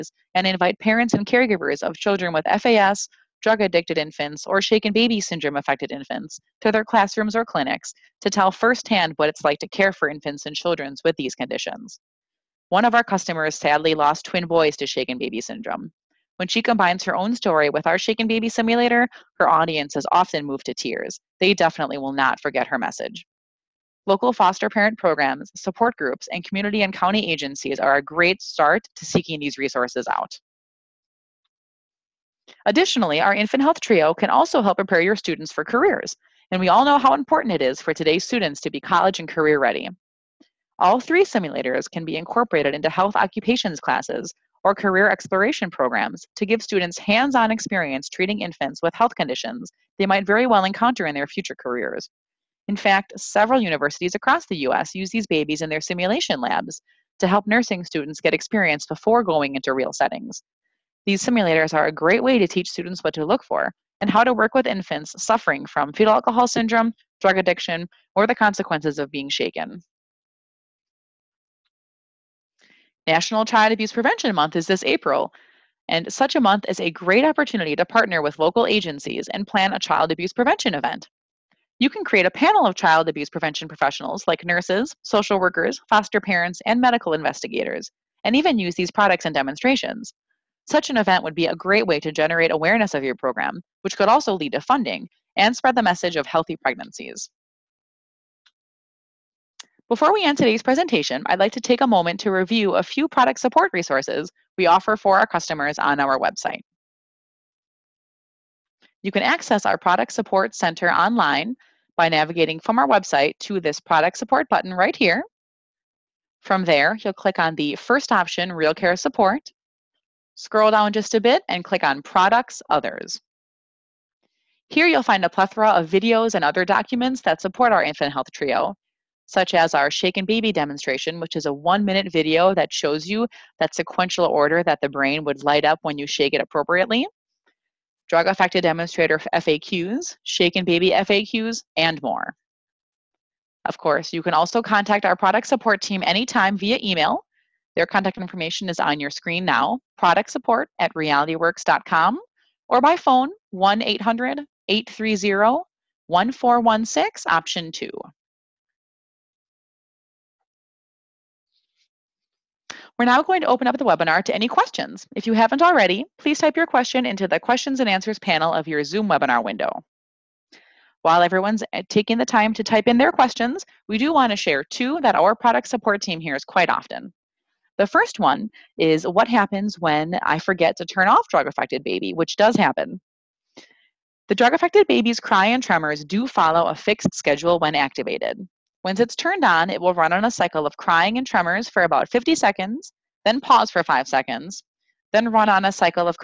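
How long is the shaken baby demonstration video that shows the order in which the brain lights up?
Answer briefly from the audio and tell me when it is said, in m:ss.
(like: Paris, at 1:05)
1 minute, at 2:11.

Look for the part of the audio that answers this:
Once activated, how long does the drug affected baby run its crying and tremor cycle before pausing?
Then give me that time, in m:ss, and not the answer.
3:12.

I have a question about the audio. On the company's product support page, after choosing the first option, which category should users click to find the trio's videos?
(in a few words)
Products Others.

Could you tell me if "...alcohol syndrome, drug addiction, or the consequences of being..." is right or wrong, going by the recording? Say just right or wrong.
right.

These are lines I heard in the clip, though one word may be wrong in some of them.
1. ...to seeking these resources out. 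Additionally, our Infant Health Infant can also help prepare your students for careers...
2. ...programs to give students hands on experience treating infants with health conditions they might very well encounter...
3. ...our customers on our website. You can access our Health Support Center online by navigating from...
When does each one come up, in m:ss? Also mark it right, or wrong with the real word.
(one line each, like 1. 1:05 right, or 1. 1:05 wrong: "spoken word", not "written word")
1. 0:28 wrong: "Trio", not "Infant"
2. 0:45 right
3. 1:45 wrong: "Product", not "Health".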